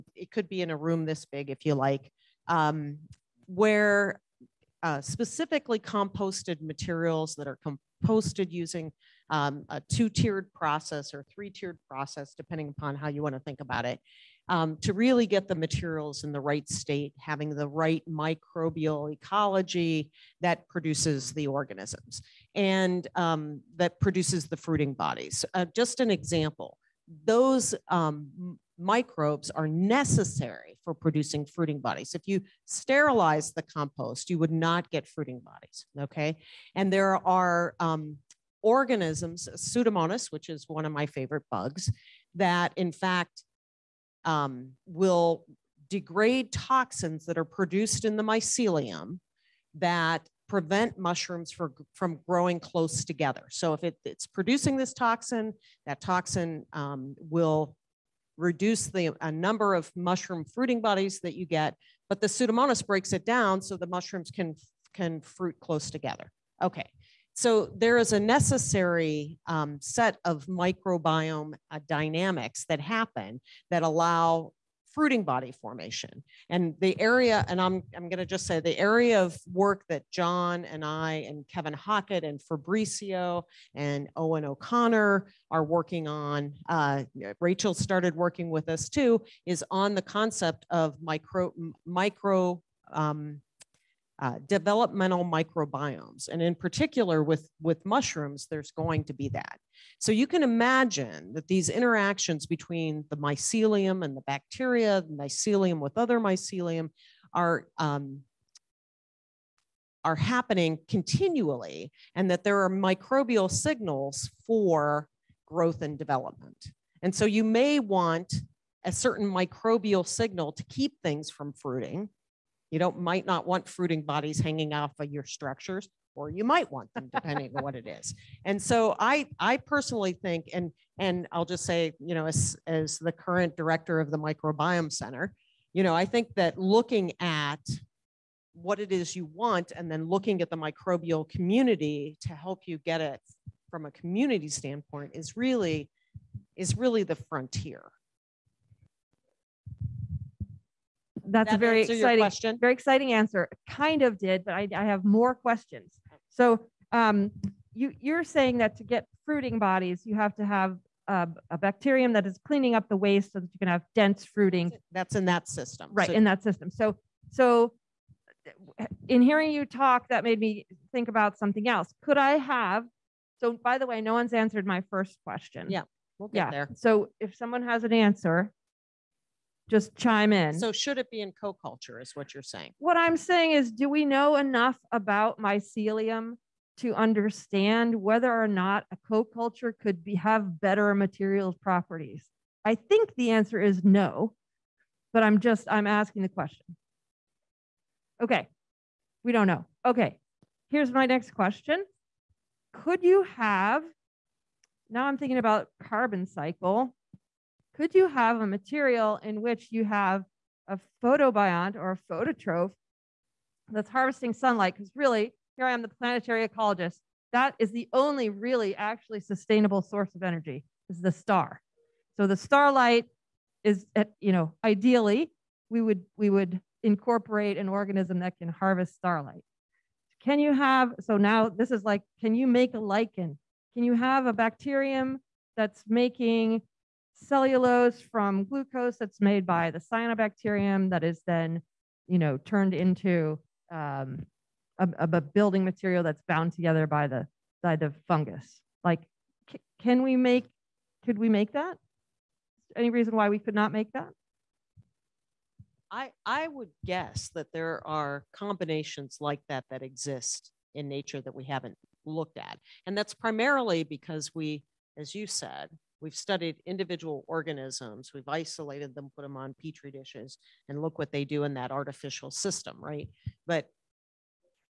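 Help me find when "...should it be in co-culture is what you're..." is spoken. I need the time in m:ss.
3:00.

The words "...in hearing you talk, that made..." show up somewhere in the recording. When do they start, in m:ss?
2:49.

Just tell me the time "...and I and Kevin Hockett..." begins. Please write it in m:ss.
1:20.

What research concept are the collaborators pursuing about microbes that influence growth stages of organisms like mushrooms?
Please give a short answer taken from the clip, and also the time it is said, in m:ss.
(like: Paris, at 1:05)
developmental microbiomes, at 1:34.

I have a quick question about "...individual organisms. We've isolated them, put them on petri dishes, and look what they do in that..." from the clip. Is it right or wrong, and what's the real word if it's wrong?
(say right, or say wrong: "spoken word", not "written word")
right.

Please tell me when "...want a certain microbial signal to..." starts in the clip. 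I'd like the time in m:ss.
1:57.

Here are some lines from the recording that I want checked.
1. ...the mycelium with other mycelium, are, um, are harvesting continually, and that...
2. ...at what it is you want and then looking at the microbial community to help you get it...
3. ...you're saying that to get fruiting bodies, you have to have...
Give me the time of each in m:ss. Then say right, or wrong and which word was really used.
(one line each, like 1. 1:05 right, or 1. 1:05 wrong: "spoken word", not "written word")
1. 1:45 wrong: "happening", not "harvesting"
2. 2:17 right
3. 2:38 right.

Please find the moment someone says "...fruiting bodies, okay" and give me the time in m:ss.
0:35.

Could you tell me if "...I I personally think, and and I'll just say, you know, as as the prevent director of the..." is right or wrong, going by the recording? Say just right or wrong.
wrong.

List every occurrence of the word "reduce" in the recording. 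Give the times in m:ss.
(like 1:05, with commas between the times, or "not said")
0:58.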